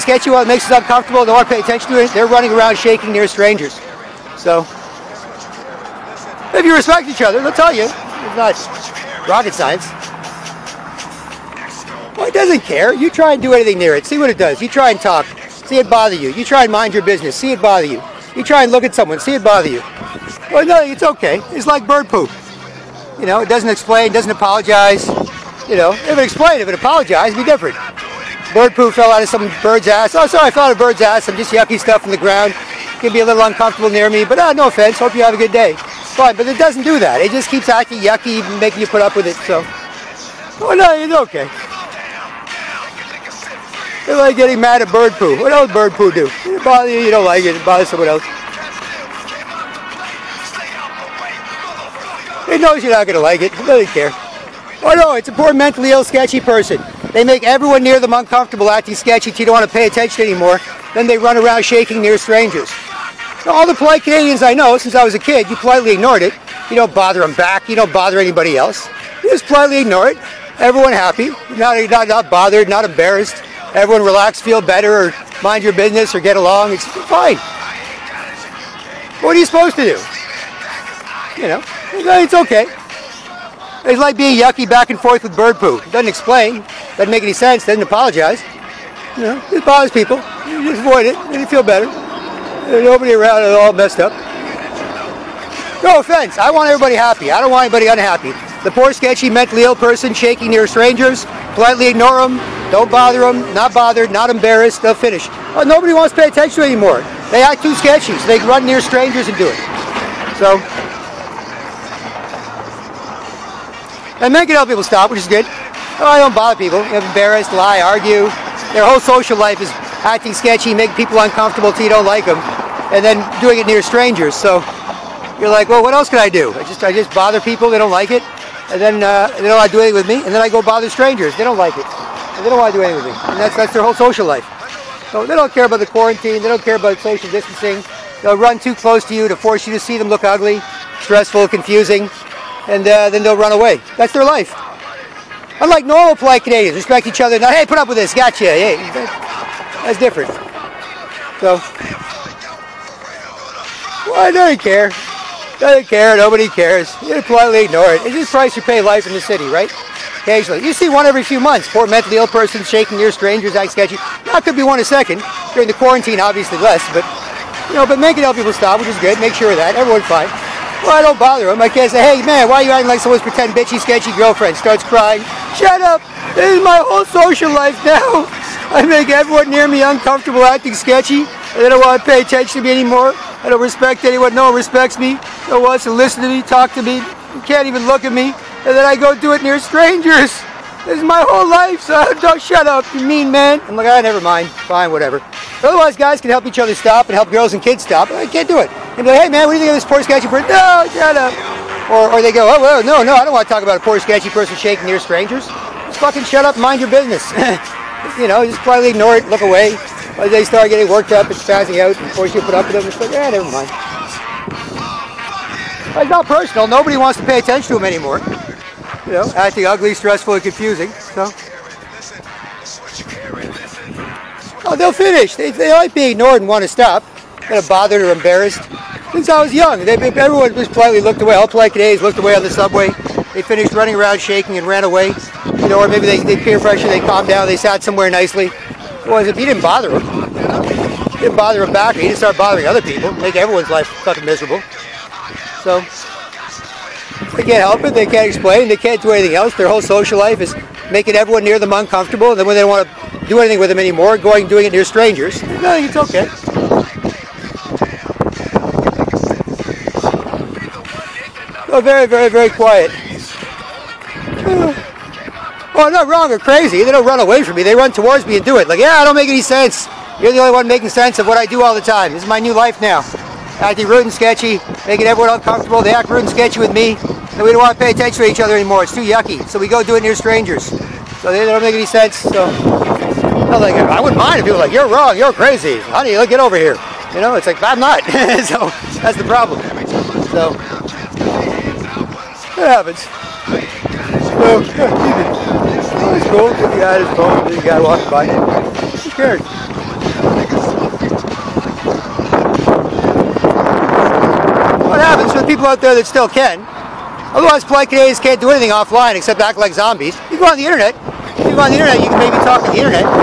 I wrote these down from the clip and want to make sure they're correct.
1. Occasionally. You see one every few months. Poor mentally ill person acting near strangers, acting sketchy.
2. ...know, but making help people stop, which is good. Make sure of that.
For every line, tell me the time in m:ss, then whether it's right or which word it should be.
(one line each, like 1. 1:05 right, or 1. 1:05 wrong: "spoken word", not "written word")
1. 2:40 wrong: "shaking", not "acting"
2. 2:47 right.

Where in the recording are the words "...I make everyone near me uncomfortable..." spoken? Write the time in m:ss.
2:58.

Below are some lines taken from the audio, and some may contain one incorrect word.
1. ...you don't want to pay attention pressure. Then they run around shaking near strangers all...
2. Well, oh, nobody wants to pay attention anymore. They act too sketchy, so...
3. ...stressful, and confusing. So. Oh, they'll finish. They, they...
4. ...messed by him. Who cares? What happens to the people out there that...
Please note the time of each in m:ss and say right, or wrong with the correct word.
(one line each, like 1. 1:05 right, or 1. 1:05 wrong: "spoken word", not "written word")
1. 0:59 wrong: "anymore", not "pressure"
2. 1:45 right
3. 3:39 right
4. 4:57 wrong: "walked", not "messed".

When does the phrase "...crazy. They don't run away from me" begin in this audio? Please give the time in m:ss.
4:26.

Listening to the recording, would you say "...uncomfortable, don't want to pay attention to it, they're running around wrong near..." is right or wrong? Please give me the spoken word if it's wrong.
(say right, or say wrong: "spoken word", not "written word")
wrong: "shaking", not "wrong".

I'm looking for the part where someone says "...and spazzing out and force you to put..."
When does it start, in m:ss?
3:31.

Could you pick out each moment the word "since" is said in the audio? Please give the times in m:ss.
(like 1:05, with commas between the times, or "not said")
1:04, 3:49.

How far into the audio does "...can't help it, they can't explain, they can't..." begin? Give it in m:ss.
4:07.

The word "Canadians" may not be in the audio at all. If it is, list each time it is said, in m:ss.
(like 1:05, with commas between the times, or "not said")
1:04, 2:26, 5:07.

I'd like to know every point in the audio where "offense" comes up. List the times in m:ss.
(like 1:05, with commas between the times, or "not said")
0:34, 1:35.